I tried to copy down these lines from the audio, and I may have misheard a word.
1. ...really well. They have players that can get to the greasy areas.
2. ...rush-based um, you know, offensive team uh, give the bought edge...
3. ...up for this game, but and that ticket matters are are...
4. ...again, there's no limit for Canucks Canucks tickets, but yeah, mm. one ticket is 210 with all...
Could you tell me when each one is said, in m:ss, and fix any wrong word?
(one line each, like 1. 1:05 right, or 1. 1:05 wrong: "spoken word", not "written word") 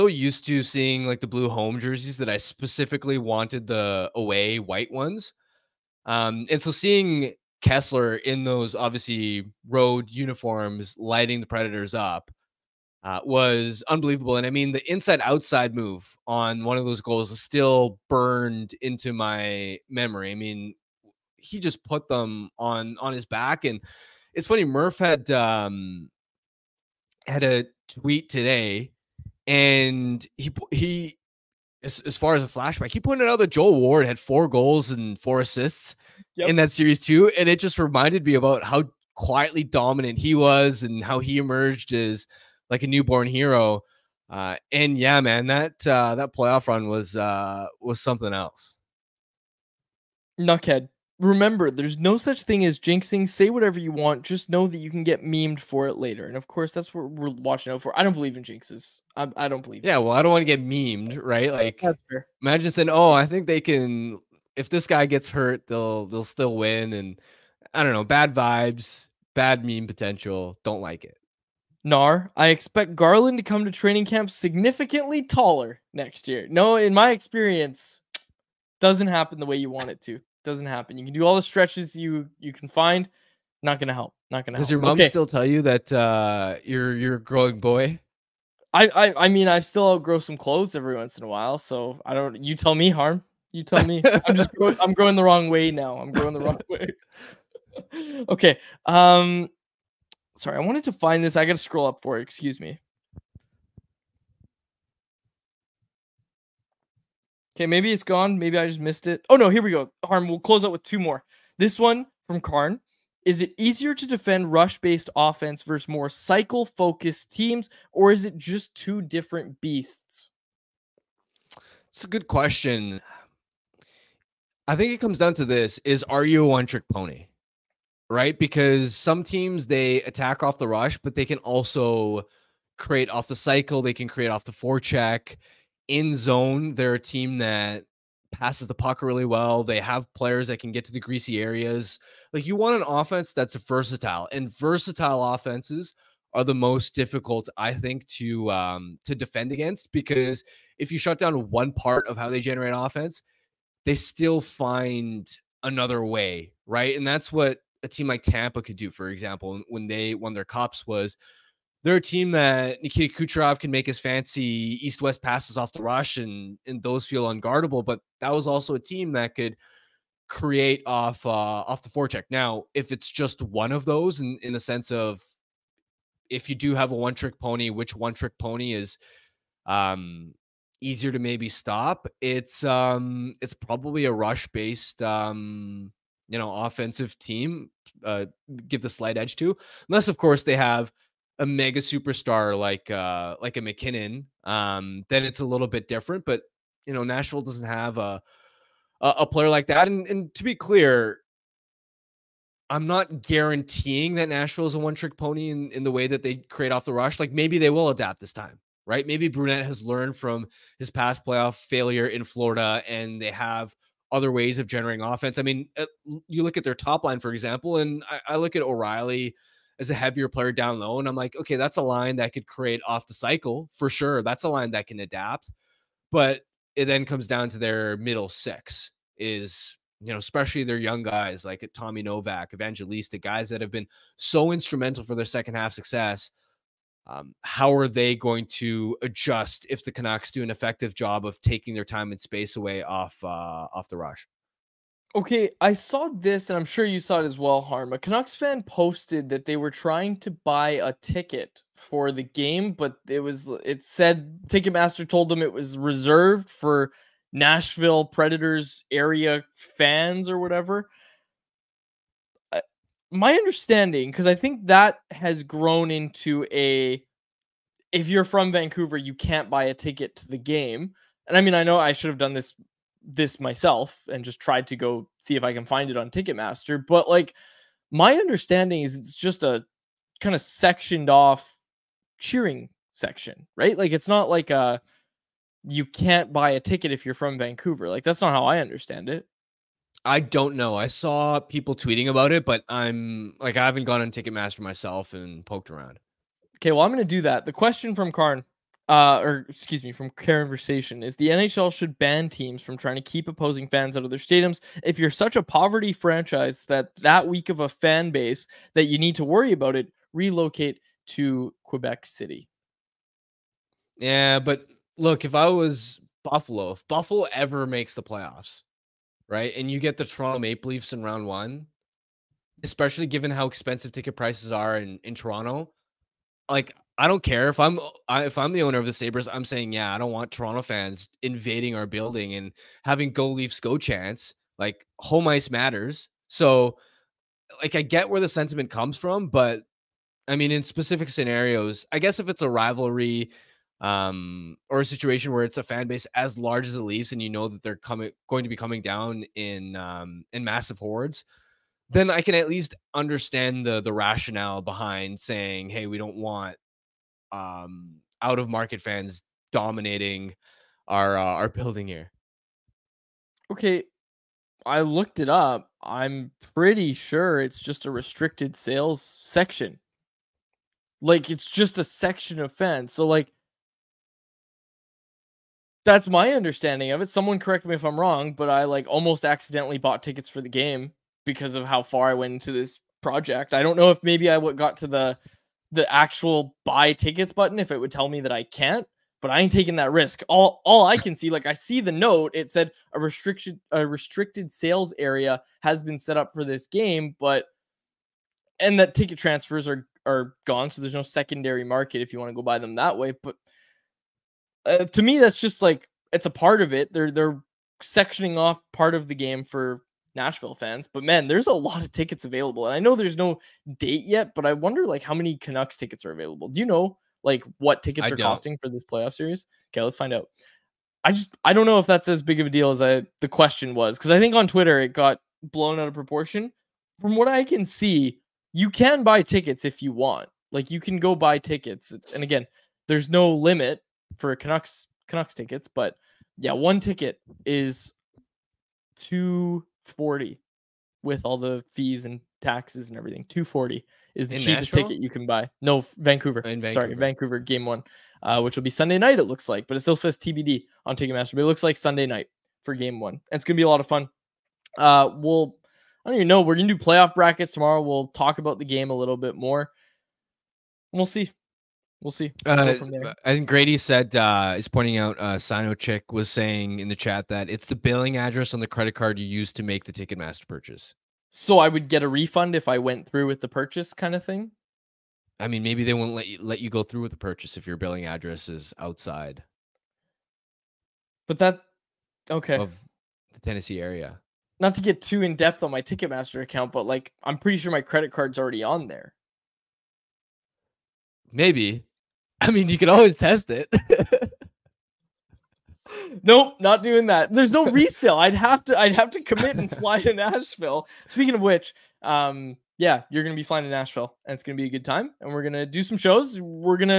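1. 2:19 right
2. 3:04 wrong: "slight", not "bought"
3. 6:36 wrong: "transfers", not "matters"
4. 7:12 wrong: "240", not "210".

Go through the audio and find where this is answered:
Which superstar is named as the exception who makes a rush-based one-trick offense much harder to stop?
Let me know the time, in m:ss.
3:13.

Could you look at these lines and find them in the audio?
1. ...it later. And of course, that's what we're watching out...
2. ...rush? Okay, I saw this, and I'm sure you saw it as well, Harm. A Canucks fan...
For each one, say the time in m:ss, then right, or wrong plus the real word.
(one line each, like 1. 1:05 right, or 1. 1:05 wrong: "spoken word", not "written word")
1. 0:55 right
2. 4:03 right.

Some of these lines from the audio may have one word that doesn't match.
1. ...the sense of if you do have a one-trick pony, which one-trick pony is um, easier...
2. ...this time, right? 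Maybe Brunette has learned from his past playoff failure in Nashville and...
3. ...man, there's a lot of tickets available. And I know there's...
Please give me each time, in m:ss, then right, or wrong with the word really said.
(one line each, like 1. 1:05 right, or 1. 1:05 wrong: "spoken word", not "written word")
1. 2:54 right
2. 3:28 wrong: "Florida", not "Nashville"
3. 6:51 right.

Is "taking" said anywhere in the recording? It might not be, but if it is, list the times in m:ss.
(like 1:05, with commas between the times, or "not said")
4:01, 6:29.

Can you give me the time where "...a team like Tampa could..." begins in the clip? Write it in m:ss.
2:37.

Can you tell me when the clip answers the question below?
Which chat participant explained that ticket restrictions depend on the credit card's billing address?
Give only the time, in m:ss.
7:45.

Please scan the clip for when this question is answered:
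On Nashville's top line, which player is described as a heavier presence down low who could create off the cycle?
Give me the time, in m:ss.
3:38.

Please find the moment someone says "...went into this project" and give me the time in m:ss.
6:22.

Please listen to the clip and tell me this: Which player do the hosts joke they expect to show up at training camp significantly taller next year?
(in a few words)
Garland.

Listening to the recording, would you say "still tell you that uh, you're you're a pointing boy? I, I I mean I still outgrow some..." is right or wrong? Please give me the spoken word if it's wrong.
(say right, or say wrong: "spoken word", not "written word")
wrong: "growing", not "pointing".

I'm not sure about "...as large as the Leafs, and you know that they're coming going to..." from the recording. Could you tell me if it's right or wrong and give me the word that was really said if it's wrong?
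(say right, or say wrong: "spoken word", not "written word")
right.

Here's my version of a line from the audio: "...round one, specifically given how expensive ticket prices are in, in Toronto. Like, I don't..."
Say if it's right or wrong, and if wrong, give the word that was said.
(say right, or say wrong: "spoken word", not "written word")
wrong: "especially", not "specifically".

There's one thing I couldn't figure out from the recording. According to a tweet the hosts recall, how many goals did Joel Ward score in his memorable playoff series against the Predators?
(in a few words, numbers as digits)
4.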